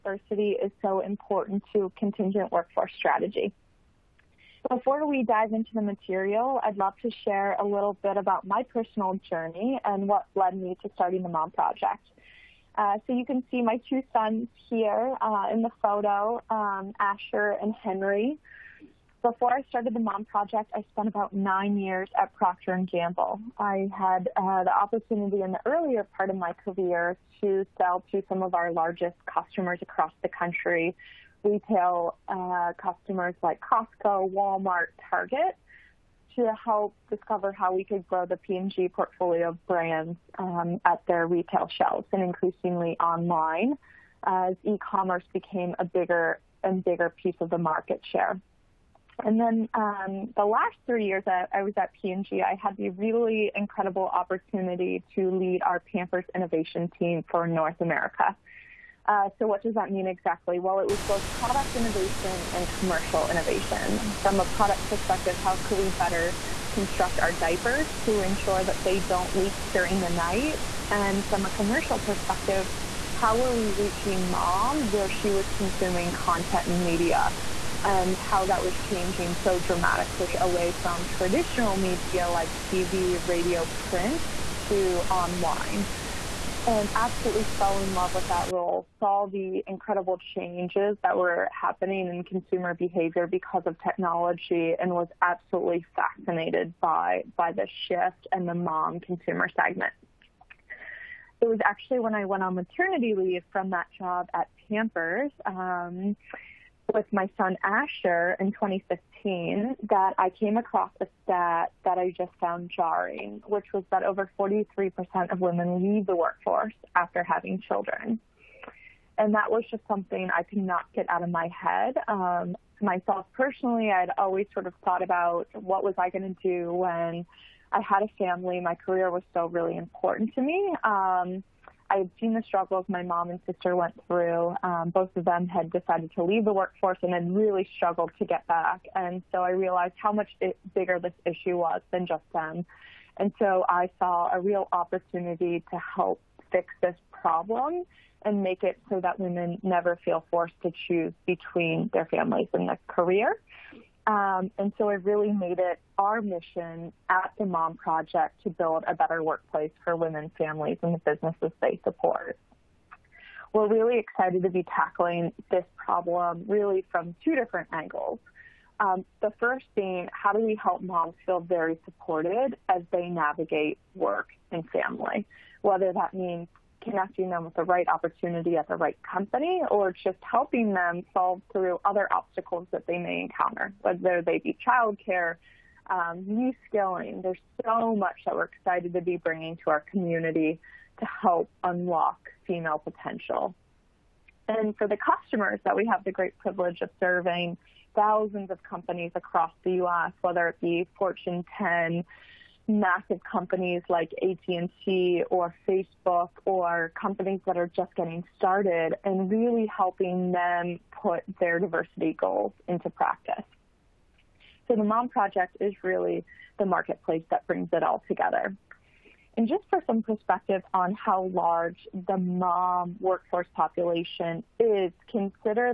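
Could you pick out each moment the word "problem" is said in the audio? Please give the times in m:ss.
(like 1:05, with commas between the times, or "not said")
2:27, 2:45.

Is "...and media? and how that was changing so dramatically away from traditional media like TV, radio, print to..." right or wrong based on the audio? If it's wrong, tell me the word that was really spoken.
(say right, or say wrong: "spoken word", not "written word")
right.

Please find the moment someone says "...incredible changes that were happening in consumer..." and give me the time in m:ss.
1:29.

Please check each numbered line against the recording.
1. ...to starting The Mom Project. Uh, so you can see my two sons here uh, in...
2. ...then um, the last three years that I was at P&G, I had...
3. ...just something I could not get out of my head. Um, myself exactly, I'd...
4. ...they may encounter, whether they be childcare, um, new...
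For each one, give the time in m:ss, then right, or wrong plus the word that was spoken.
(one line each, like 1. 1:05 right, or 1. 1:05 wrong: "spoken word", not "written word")
1. 0:10 right
2. 0:49 right
3. 1:59 wrong: "personally", not "exactly"
4. 3:02 right.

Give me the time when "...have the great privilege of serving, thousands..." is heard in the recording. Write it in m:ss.
3:15.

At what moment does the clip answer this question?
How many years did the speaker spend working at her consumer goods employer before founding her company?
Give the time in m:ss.
0:21.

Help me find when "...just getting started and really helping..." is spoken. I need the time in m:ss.
3:27.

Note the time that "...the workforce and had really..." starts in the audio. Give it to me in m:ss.
2:16.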